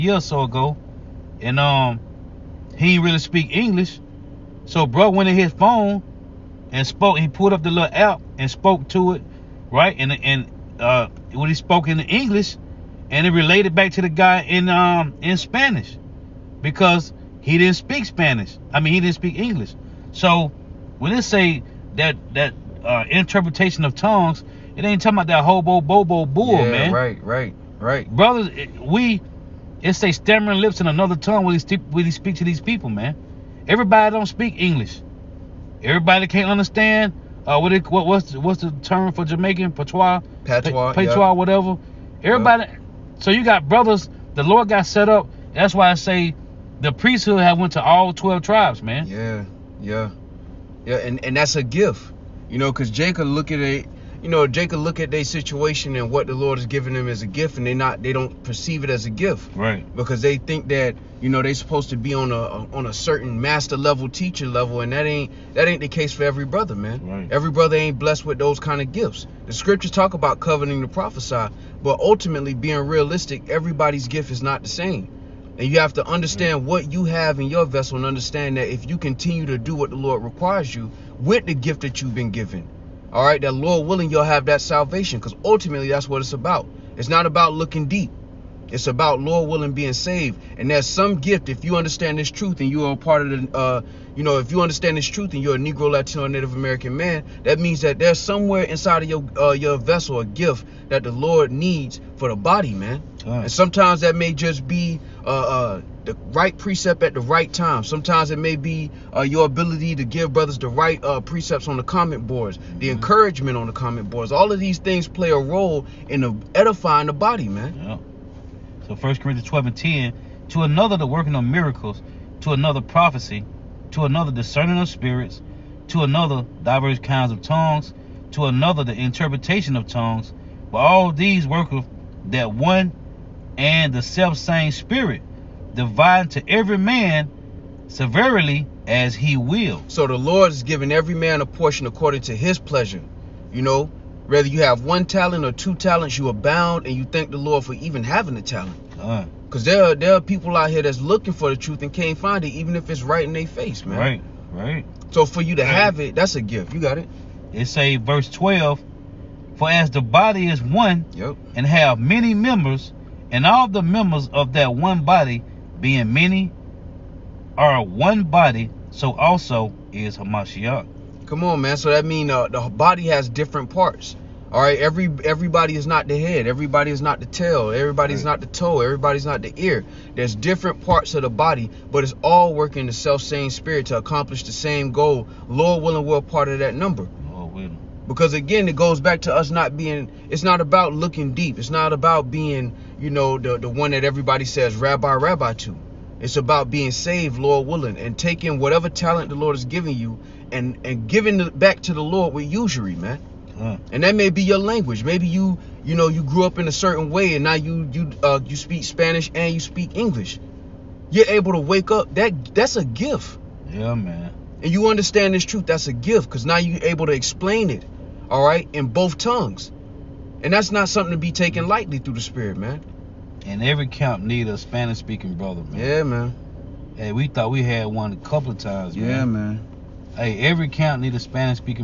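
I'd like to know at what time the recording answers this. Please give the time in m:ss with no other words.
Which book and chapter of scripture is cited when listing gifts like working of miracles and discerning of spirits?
1:58.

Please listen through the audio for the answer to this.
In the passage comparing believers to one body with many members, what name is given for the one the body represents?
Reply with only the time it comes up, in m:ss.
2:50.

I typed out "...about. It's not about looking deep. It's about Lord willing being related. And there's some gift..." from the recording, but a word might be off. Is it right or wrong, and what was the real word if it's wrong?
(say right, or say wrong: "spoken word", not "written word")
wrong: "saved", not "related".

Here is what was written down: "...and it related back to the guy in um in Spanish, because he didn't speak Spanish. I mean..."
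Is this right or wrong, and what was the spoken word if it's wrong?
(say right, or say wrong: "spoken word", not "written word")
right.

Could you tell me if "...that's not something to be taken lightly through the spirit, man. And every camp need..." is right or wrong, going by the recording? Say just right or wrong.
right.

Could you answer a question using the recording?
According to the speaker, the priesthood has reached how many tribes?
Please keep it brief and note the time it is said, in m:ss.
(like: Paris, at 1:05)
12, at 0:48.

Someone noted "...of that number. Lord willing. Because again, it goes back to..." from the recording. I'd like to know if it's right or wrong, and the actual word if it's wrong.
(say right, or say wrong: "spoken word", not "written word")
right.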